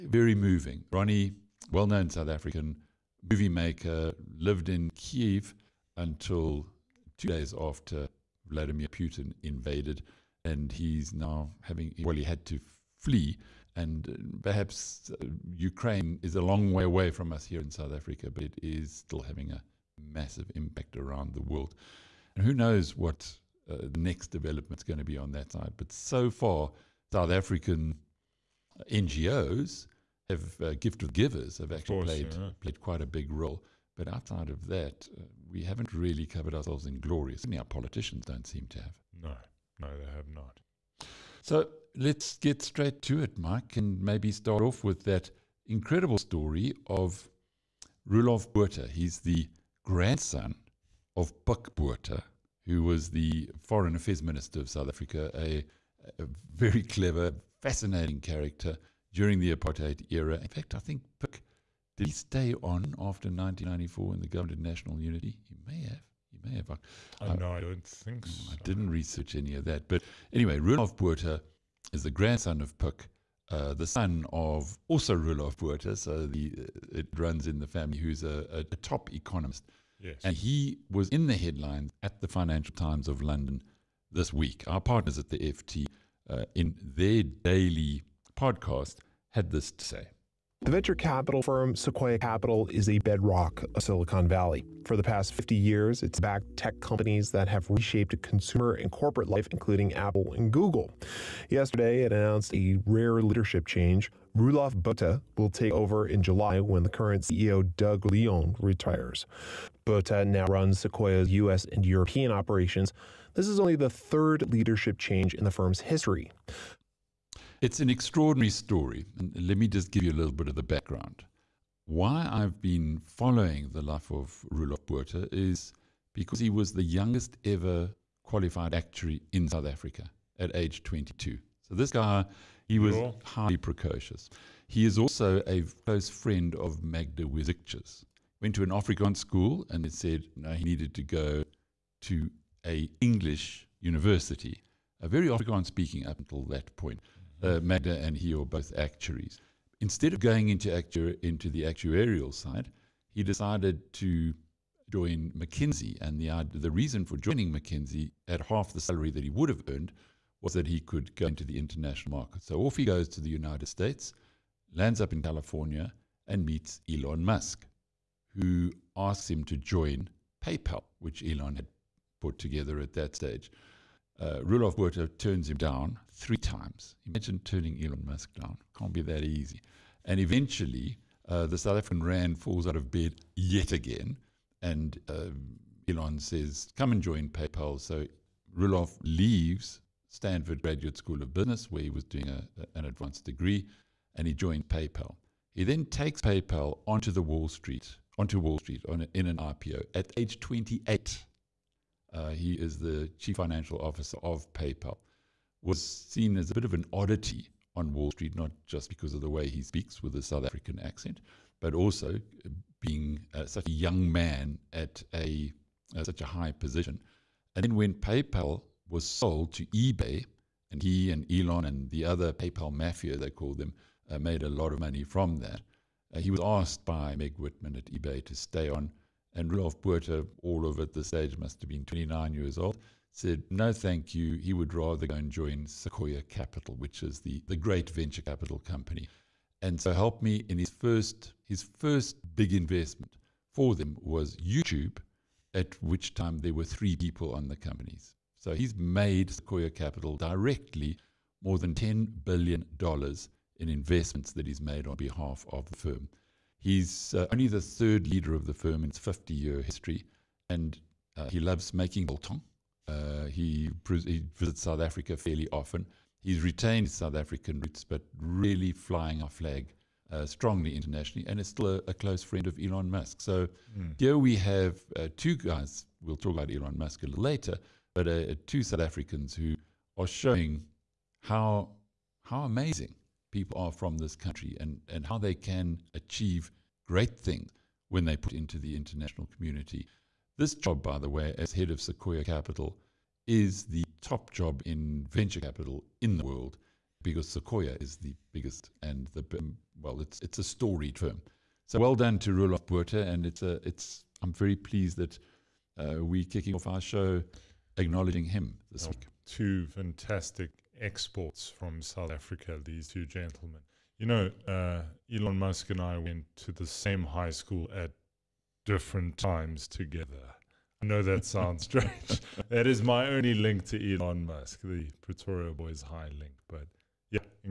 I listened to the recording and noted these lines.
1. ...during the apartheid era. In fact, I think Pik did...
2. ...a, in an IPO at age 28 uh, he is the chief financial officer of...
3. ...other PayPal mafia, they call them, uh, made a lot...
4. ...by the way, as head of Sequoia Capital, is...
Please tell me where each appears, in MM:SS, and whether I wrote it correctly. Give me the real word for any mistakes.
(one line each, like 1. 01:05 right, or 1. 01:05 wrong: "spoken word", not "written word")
1. 00:59 right
2. 03:19 right
3. 03:42 right
4. 04:50 right.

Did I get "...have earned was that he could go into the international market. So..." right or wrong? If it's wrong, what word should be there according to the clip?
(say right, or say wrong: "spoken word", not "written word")
right.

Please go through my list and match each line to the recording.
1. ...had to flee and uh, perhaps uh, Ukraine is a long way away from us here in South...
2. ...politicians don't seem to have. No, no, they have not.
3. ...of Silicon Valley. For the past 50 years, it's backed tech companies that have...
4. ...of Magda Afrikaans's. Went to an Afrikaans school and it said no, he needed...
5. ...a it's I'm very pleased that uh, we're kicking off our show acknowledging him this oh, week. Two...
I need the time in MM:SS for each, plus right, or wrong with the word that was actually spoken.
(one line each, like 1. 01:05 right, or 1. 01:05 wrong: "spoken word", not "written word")
1. 00:12 right
2. 00:37 right
3. 01:33 right
4. 02:16 wrong: "Wierzycka", not "Afrikaans"
5. 05:03 right.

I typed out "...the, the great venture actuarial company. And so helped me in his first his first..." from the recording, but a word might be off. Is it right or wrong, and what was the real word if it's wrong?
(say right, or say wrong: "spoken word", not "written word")
wrong: "capital", not "actuarial".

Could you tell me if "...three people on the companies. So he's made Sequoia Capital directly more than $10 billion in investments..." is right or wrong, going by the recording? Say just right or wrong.
right.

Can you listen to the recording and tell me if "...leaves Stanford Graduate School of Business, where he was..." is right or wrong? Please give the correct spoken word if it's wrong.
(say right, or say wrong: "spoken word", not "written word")
right.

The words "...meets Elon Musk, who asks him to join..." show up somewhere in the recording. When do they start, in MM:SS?
02:46.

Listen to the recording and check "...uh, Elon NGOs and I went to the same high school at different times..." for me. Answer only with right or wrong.
wrong.